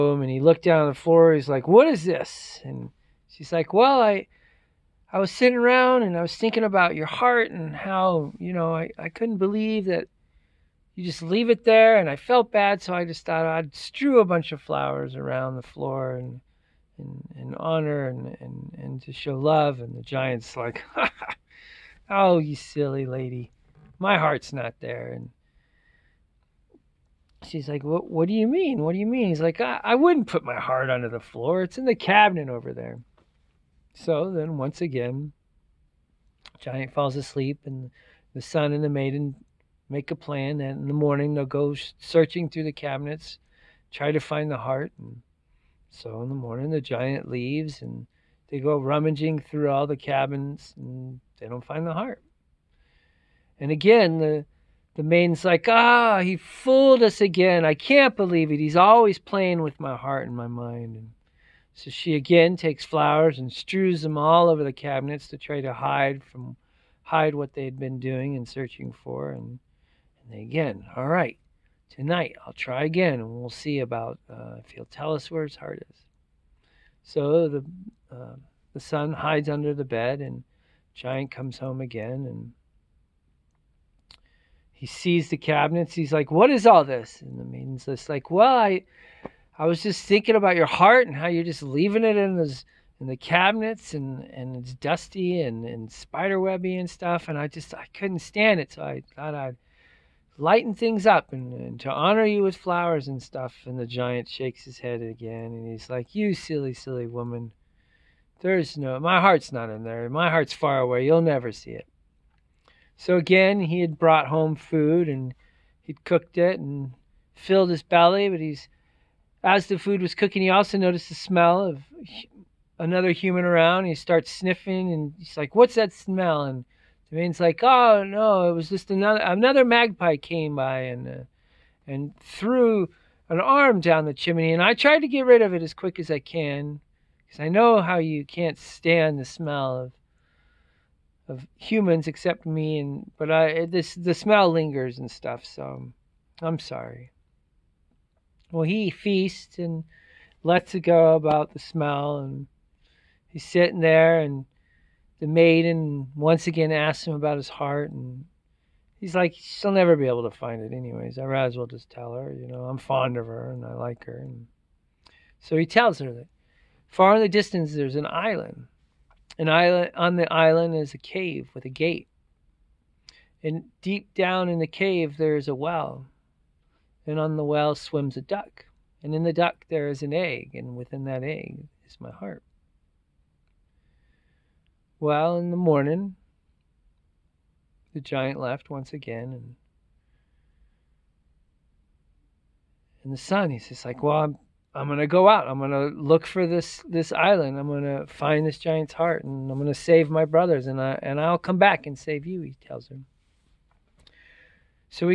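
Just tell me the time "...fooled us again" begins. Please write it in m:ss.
0:56.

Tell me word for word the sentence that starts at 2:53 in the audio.
And deep down in the cave there is a well.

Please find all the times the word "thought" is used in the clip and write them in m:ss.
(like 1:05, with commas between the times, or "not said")
0:13, 1:39.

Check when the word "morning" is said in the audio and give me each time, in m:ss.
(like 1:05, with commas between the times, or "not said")
0:40, 0:46, 3:05.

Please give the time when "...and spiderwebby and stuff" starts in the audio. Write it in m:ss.
1:35.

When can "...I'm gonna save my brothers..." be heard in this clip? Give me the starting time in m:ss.
3:19.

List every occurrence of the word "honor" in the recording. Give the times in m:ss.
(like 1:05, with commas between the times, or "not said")
0:17, 1:41.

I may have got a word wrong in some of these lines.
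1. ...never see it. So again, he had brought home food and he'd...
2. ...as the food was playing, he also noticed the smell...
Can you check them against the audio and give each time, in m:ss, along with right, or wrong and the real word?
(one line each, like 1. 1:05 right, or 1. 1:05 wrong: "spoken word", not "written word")
1. 1:51 right
2. 1:59 wrong: "cooking", not "playing".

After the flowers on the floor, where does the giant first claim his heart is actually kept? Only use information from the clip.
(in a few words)
In the cabinet.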